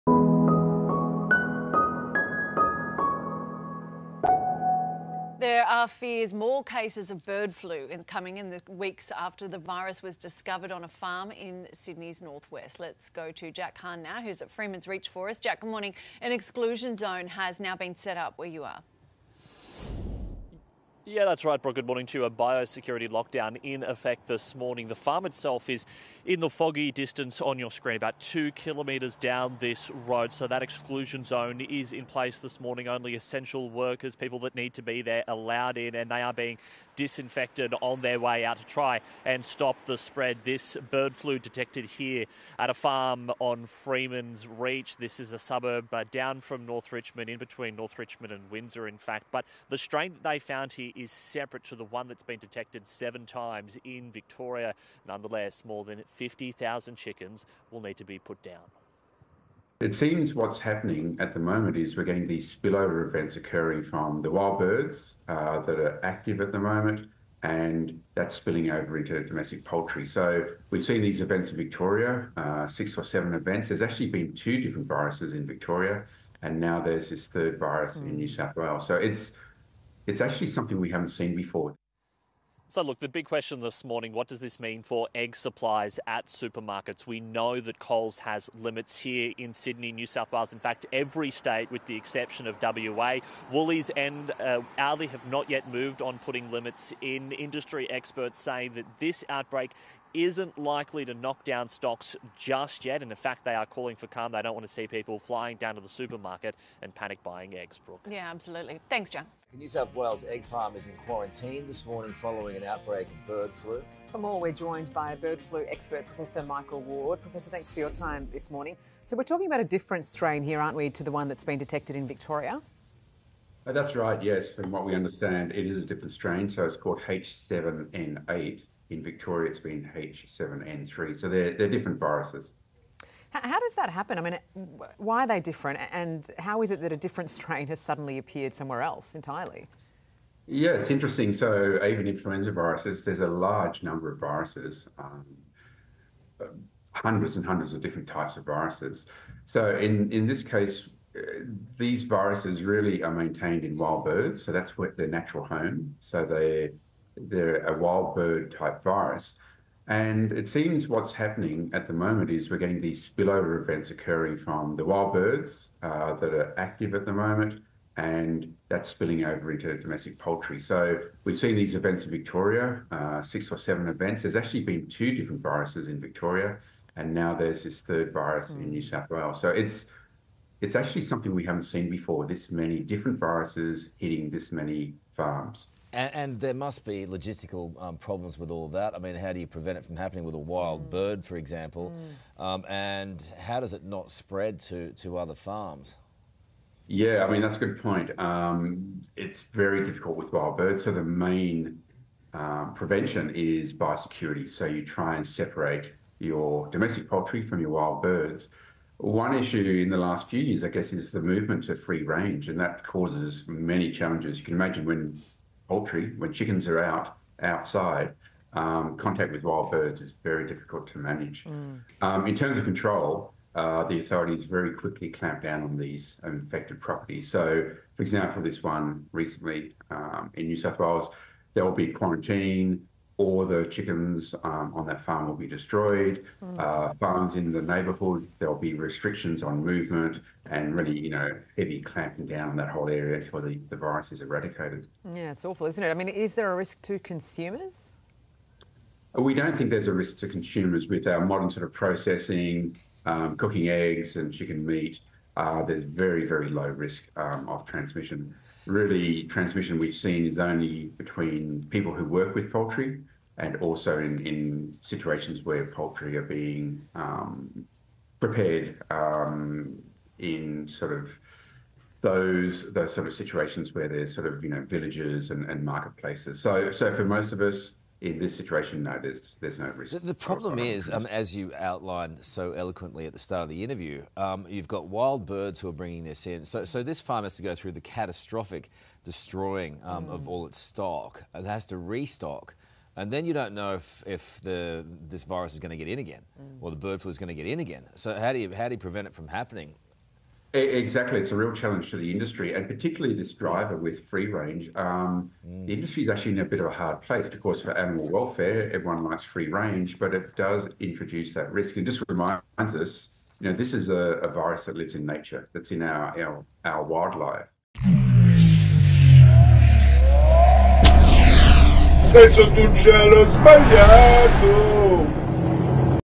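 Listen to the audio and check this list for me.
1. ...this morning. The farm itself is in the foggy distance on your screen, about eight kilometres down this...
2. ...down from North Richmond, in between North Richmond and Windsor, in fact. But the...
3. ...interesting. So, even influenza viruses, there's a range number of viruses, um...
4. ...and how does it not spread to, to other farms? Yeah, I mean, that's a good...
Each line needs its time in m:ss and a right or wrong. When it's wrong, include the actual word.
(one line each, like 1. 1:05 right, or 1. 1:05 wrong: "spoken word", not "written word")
1. 0:24 wrong: "two", not "eight"
2. 0:46 right
3. 2:20 wrong: "large", not "range"
4. 3:12 right.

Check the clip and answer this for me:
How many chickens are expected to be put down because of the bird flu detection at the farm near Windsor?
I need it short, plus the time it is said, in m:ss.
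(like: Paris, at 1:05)
More than 50,000, at 0:55.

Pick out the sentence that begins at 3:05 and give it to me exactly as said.
And, and, there must be logistical um, problems with all of that.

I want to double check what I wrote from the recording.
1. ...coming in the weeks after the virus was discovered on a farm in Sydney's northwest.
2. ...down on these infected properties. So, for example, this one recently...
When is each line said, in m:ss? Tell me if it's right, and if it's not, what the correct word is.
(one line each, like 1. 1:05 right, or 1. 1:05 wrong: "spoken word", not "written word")
1. 0:08 right
2. 3:45 right.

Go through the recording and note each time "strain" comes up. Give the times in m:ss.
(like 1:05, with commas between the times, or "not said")
0:49, 2:00, 2:06, 2:17.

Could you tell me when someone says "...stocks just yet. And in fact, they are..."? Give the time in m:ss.
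1:41.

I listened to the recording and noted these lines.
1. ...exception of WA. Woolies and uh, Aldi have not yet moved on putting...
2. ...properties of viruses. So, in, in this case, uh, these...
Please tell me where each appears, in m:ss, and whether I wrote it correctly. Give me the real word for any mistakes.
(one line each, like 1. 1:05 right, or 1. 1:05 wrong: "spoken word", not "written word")
1. 1:31 right
2. 2:28 wrong: "types", not "properties".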